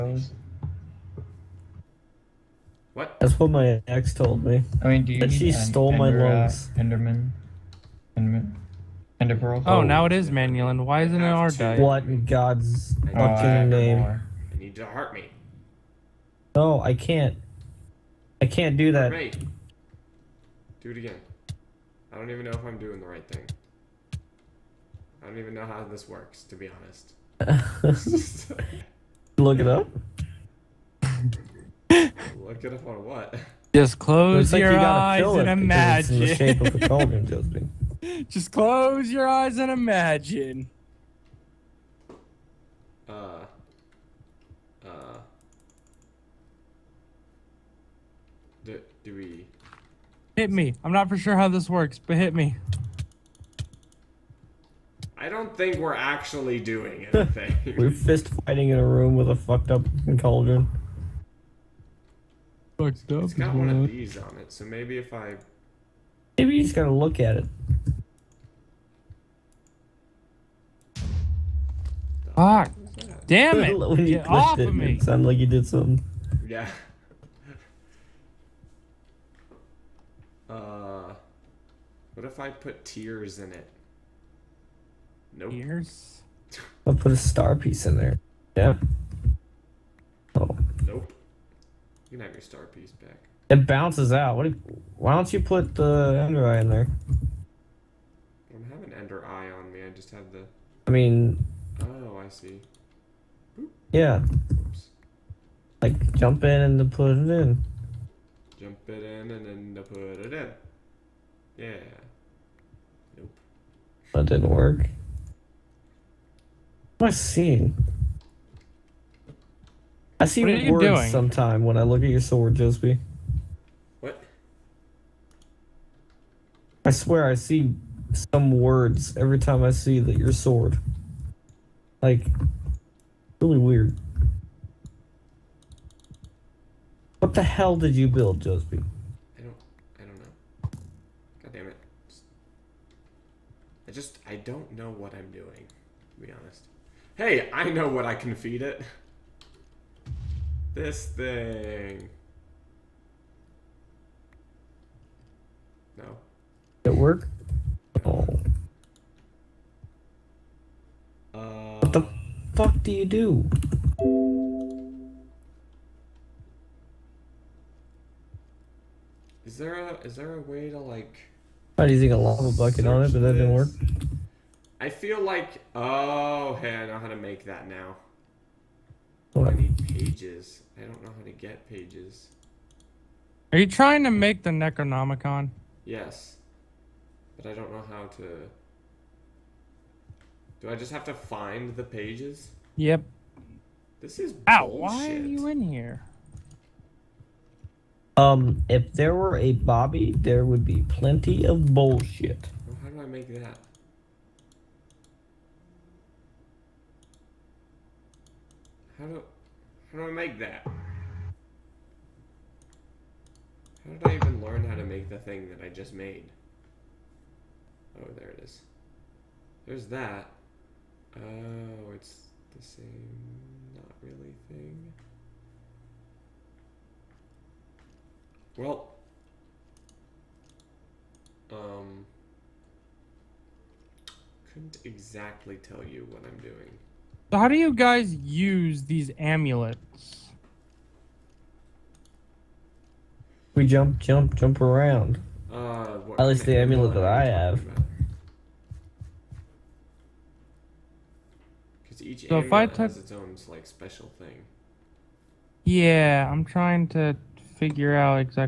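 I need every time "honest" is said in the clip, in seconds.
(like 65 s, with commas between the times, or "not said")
26 s, 146 s.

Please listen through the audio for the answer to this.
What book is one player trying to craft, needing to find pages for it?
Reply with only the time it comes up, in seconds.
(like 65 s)
184 s.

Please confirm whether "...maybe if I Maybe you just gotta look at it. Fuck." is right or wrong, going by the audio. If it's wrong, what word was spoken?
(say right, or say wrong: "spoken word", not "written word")
right.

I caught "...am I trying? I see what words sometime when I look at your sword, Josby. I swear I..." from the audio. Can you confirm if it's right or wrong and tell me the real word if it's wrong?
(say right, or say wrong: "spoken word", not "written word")
wrong: "seeing", not "trying".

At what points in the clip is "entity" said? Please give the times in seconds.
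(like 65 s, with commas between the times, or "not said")
not said.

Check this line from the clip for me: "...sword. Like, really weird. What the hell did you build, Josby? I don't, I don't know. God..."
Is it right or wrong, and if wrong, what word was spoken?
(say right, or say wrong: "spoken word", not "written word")
right.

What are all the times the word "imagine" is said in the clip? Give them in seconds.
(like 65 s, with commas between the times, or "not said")
35 s, 39 s.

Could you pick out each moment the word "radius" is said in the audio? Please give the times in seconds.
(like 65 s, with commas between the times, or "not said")
not said.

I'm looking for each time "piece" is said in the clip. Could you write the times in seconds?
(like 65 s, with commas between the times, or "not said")
87 s, 92 s.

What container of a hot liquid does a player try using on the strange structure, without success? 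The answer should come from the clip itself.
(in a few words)
lava bucket.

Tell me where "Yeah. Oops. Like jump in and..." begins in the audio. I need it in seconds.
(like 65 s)
103 s.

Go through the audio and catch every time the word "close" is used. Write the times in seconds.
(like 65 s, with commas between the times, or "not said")
33 s, 38 s.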